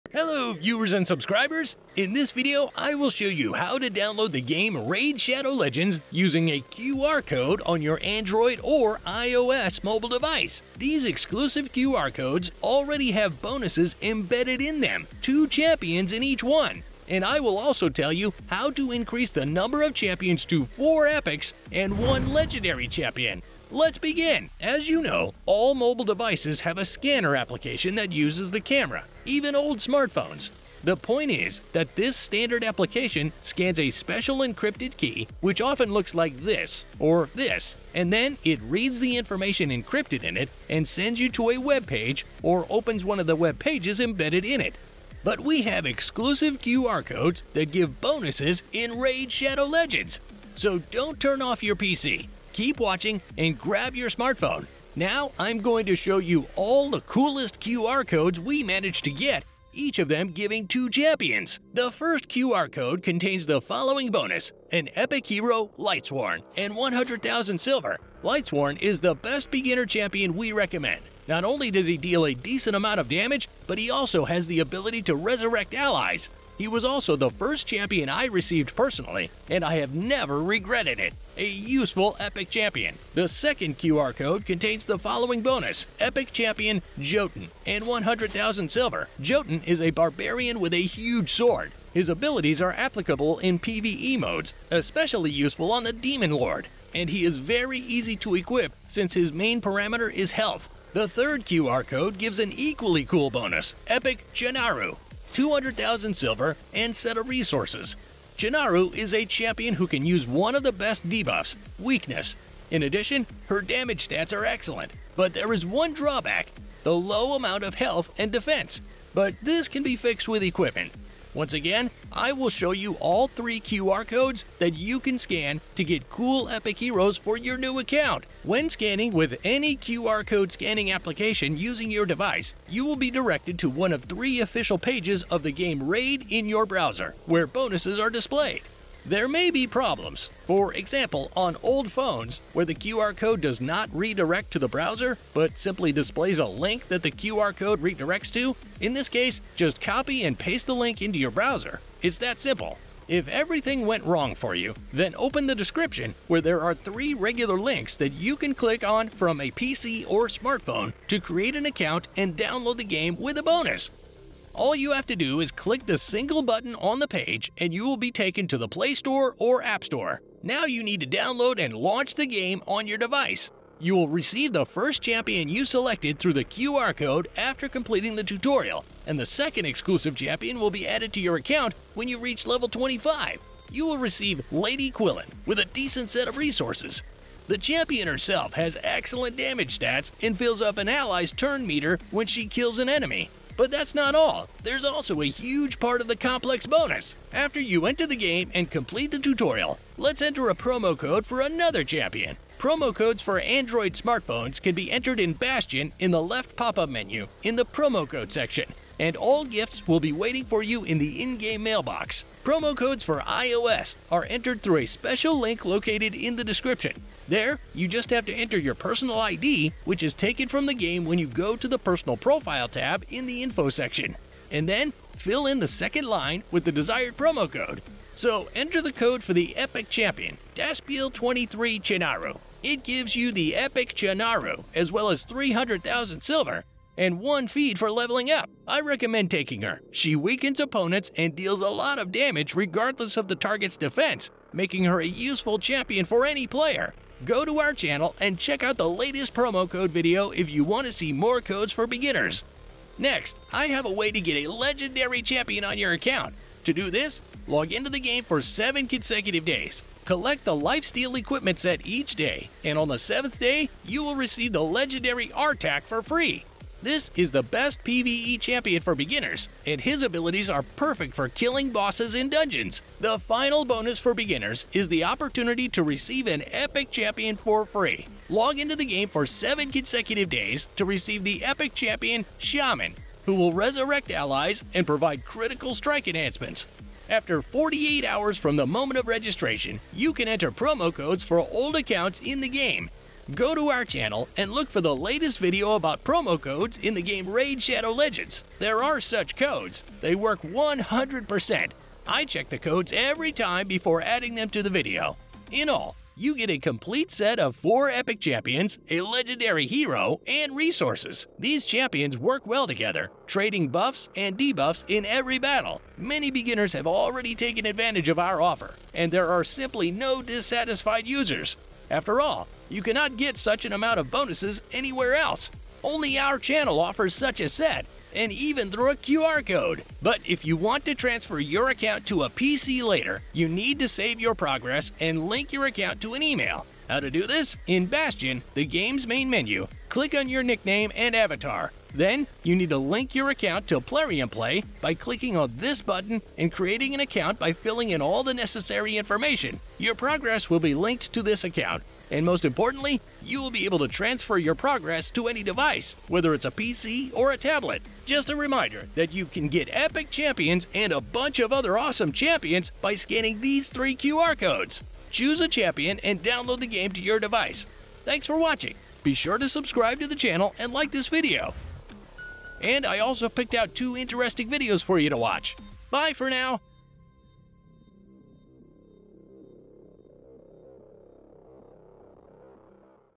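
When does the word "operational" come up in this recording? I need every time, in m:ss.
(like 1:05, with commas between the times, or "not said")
not said.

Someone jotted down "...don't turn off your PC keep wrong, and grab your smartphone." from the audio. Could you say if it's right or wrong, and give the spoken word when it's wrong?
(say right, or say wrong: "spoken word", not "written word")
wrong: "watching", not "wrong".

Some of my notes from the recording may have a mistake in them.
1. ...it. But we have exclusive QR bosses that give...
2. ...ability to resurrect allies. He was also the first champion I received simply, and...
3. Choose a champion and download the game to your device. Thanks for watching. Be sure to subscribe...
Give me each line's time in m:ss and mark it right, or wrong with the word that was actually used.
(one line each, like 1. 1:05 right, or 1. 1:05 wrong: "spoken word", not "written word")
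1. 0:44 wrong: "codes", not "bosses"
2. 1:14 wrong: "personally", not "simply"
3. 6:05 right.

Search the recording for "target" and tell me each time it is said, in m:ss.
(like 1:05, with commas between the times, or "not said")
4:03.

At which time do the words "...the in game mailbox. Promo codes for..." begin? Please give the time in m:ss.
3:30.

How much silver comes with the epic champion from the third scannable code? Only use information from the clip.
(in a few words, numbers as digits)
200,000.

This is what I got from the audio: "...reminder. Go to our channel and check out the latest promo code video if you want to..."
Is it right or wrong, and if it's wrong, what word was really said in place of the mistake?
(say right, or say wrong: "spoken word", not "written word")
wrong: "player", not "reminder".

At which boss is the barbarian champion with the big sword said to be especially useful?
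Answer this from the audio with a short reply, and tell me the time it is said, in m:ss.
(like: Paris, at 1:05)
Demon Lord, at 1:35.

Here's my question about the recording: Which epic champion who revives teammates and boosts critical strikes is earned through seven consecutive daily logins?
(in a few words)
Shaman.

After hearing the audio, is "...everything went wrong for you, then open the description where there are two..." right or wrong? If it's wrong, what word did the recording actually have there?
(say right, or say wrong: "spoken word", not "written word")
wrong: "three", not "two".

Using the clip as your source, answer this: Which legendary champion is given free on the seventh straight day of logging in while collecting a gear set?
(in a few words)
Artak.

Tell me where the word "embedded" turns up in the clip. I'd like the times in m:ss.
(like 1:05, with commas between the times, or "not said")
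0:14, 0:44.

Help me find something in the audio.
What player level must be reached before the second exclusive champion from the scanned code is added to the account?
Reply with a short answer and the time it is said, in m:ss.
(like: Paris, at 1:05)
25, at 3:02.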